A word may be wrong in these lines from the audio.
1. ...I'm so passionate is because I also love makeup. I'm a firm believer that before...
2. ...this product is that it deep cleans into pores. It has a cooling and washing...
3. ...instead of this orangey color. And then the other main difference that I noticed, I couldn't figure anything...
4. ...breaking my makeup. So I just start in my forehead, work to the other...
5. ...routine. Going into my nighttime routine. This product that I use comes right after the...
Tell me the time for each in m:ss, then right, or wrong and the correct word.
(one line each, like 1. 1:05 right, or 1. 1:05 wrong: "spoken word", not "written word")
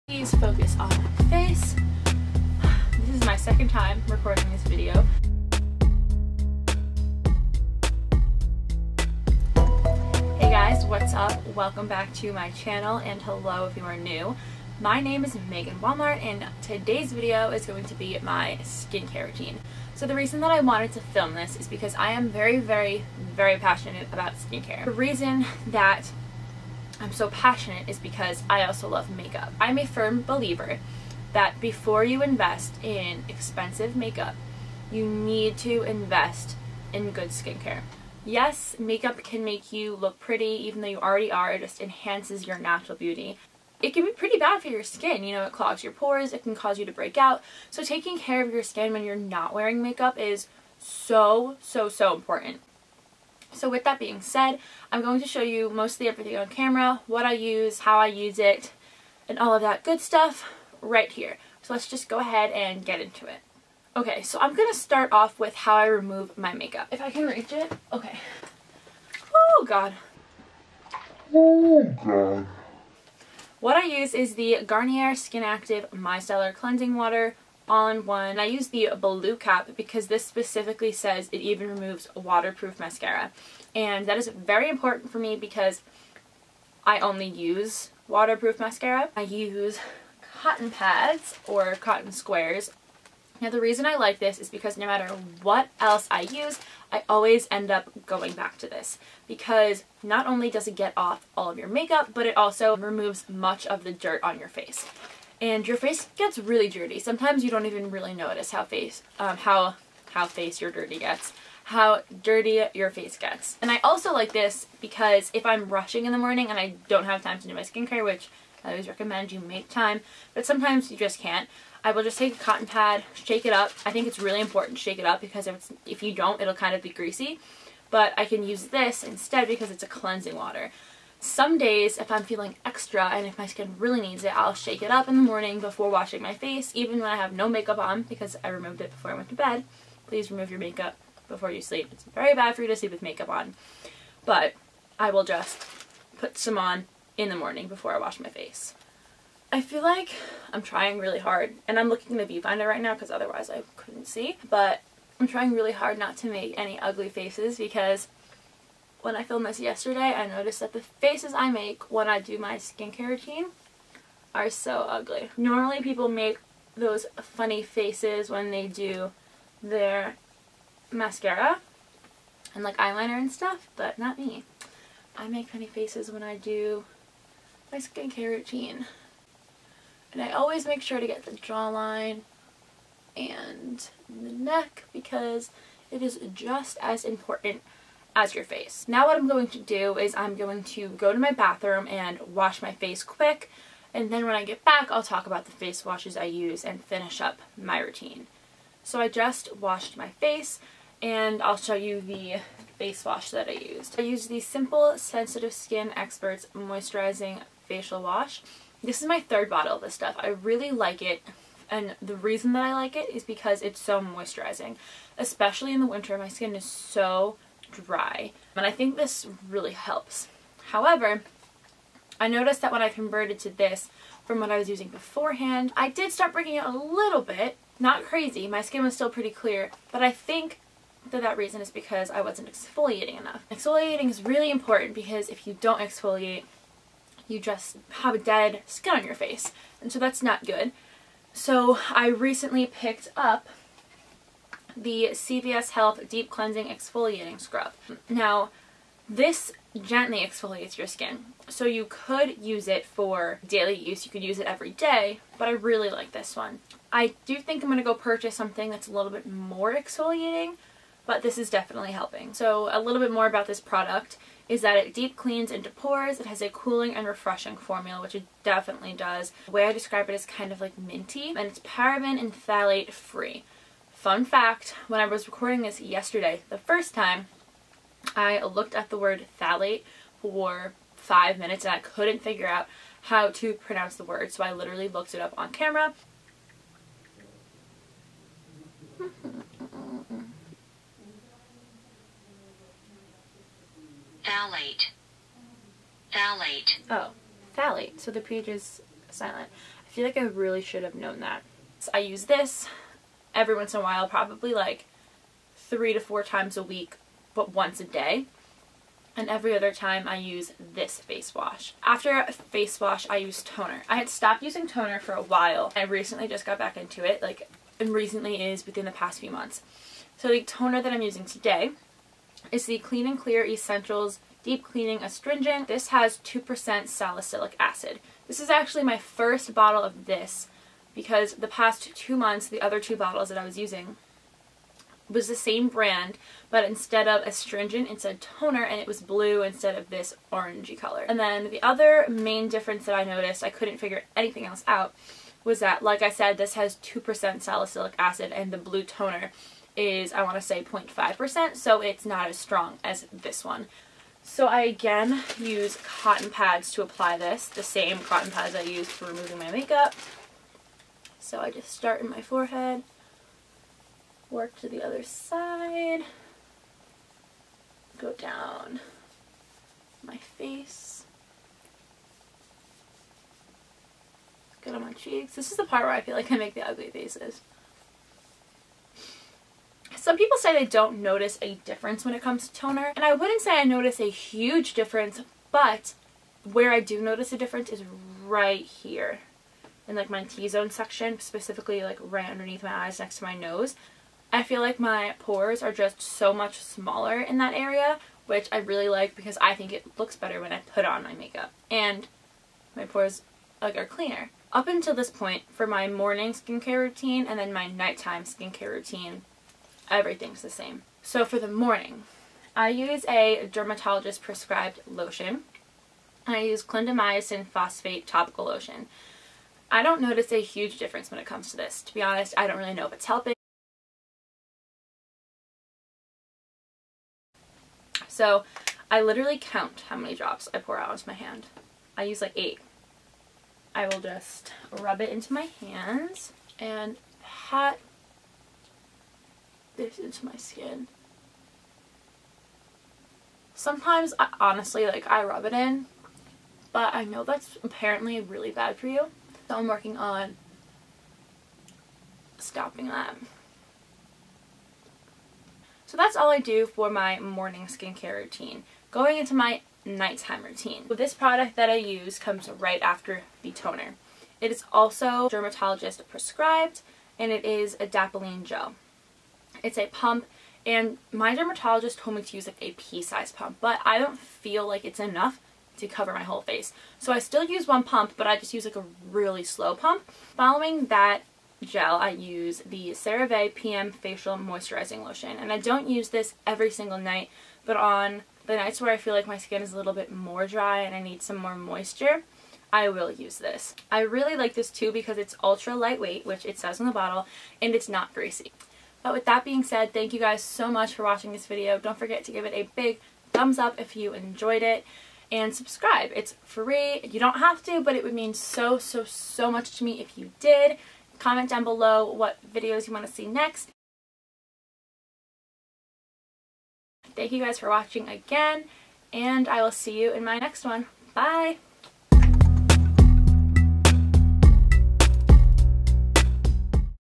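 1. 0:27 right
2. 4:23 wrong: "refreshing", not "washing"
3. 5:39 right
4. 5:59 wrong: "removing", not "breaking"
5. 7:38 right.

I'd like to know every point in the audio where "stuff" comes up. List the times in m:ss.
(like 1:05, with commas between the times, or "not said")
0:59, 2:53, 3:29.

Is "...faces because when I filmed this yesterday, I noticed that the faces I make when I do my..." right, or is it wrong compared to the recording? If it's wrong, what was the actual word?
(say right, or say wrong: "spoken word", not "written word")
right.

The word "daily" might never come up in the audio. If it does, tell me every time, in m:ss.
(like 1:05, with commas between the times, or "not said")
4:13.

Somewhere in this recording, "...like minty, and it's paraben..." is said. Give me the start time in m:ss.
4:30.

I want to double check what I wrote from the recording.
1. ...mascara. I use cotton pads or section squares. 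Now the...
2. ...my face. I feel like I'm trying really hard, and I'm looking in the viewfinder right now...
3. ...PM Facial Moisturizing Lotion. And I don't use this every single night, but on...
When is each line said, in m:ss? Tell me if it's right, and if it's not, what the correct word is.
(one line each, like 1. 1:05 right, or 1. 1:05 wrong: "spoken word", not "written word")
1. 1:28 wrong: "cotton", not "section"
2. 2:28 right
3. 8:03 right.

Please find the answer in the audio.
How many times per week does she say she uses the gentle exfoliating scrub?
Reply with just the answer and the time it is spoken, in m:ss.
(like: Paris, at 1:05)
3 to 4, at 5:05.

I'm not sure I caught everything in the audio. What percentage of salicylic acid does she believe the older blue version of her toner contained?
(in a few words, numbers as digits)
0.5%.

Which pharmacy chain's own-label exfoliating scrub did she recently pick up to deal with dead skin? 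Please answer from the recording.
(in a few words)
CVS.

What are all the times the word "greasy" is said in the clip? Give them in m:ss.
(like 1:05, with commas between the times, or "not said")
2:06, 8:18.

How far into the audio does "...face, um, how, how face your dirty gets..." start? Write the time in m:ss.
1:48.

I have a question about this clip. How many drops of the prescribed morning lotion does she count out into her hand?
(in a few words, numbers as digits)
8.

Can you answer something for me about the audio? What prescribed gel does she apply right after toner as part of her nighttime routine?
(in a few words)
Adapalene gel.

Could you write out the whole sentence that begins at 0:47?
So taking care of your skin when you're not wearing makeup is so, so, so important.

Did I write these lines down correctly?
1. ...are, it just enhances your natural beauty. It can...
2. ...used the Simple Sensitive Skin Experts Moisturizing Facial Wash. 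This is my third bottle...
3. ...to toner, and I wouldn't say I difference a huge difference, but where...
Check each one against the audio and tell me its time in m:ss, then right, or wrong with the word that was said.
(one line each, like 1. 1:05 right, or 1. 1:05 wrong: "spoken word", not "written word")
1. 0:41 right
2. 3:24 right
3. 6:22 wrong: "notice", not "difference".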